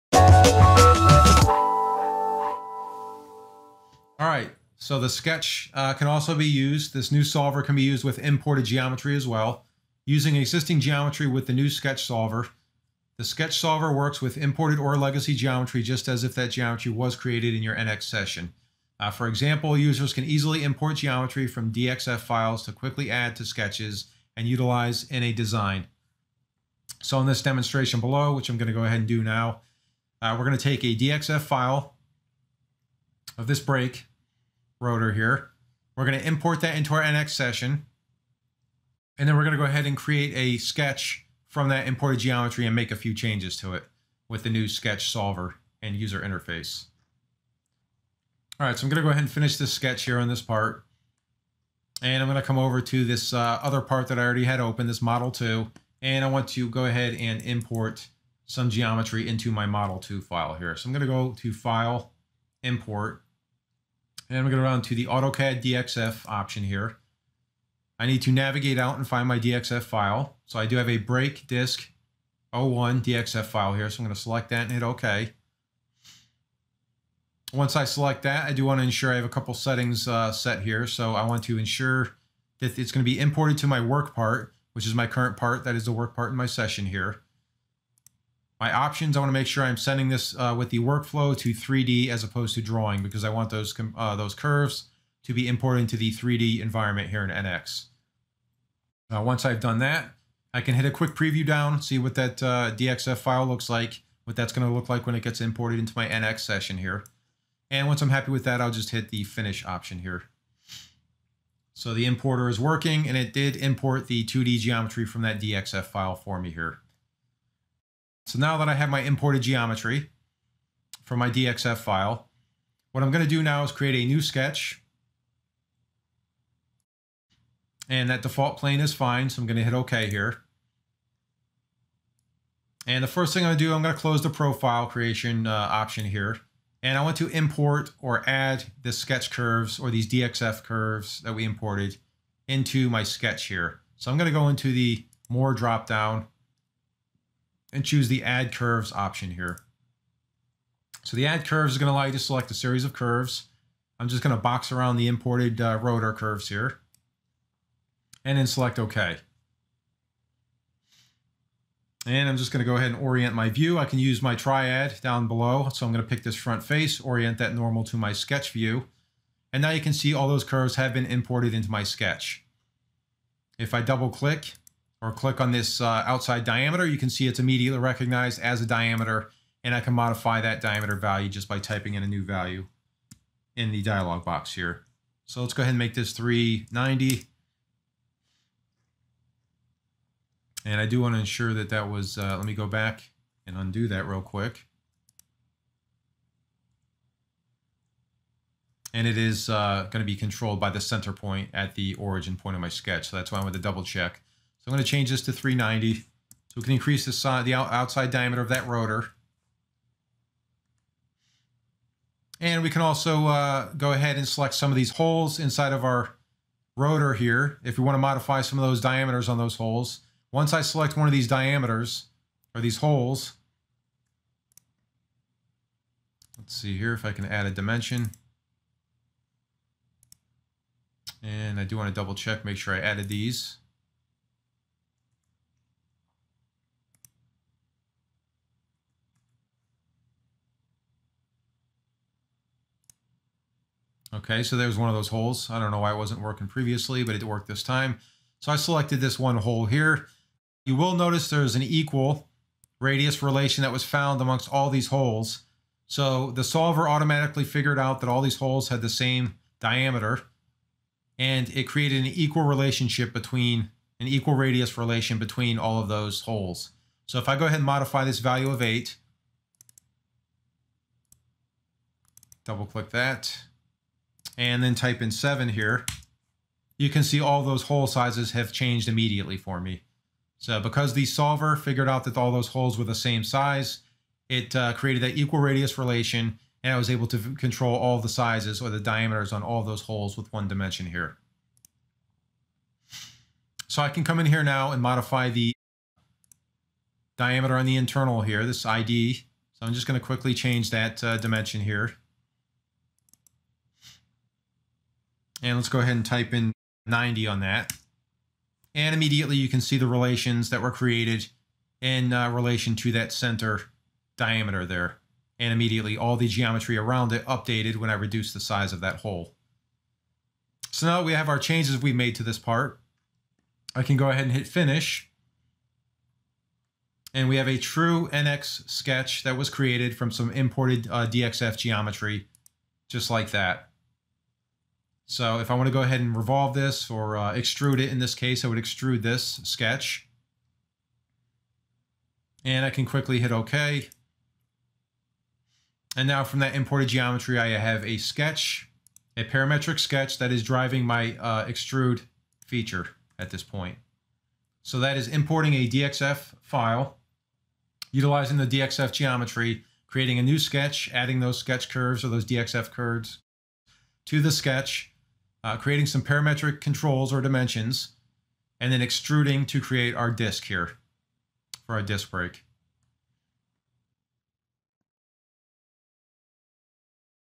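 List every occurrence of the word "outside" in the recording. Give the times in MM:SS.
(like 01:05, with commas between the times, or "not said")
02:56, 03:27.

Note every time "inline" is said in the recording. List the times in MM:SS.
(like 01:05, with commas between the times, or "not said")
not said.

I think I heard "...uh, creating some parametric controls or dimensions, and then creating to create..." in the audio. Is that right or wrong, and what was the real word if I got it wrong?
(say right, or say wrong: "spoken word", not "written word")
wrong: "extruding", not "creating".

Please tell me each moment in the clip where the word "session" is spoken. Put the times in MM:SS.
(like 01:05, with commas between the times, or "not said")
00:18, 00:37, 01:26, 01:46.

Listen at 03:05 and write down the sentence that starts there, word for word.
So let's go ahead and make this 390.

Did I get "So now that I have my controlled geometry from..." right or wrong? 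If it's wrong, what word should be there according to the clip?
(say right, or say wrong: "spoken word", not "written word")
wrong: "imported", not "controlled".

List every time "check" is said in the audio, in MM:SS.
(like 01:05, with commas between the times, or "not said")
03:23, 03:52.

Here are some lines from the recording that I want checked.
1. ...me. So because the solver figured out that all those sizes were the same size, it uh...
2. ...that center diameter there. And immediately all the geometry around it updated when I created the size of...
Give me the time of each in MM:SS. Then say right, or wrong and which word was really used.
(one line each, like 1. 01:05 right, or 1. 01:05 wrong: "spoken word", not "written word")
1. 04:39 wrong: "holes", not "sizes"
2. 05:12 wrong: "reduced", not "created".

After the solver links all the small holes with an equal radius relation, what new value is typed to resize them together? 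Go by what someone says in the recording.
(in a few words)
7.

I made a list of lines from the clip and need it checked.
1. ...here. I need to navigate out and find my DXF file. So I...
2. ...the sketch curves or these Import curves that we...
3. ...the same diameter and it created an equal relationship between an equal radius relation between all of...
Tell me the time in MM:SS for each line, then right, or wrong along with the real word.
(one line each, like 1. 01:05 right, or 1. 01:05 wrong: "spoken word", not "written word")
1. 01:06 right
2. 02:18 wrong: "DXF", not "Import"
3. 04:18 right.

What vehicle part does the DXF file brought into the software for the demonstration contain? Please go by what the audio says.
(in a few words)
brake rotor.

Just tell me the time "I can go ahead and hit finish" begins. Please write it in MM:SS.
05:23.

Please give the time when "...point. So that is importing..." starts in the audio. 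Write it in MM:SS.
05:53.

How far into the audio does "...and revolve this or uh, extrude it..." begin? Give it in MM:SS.
05:35.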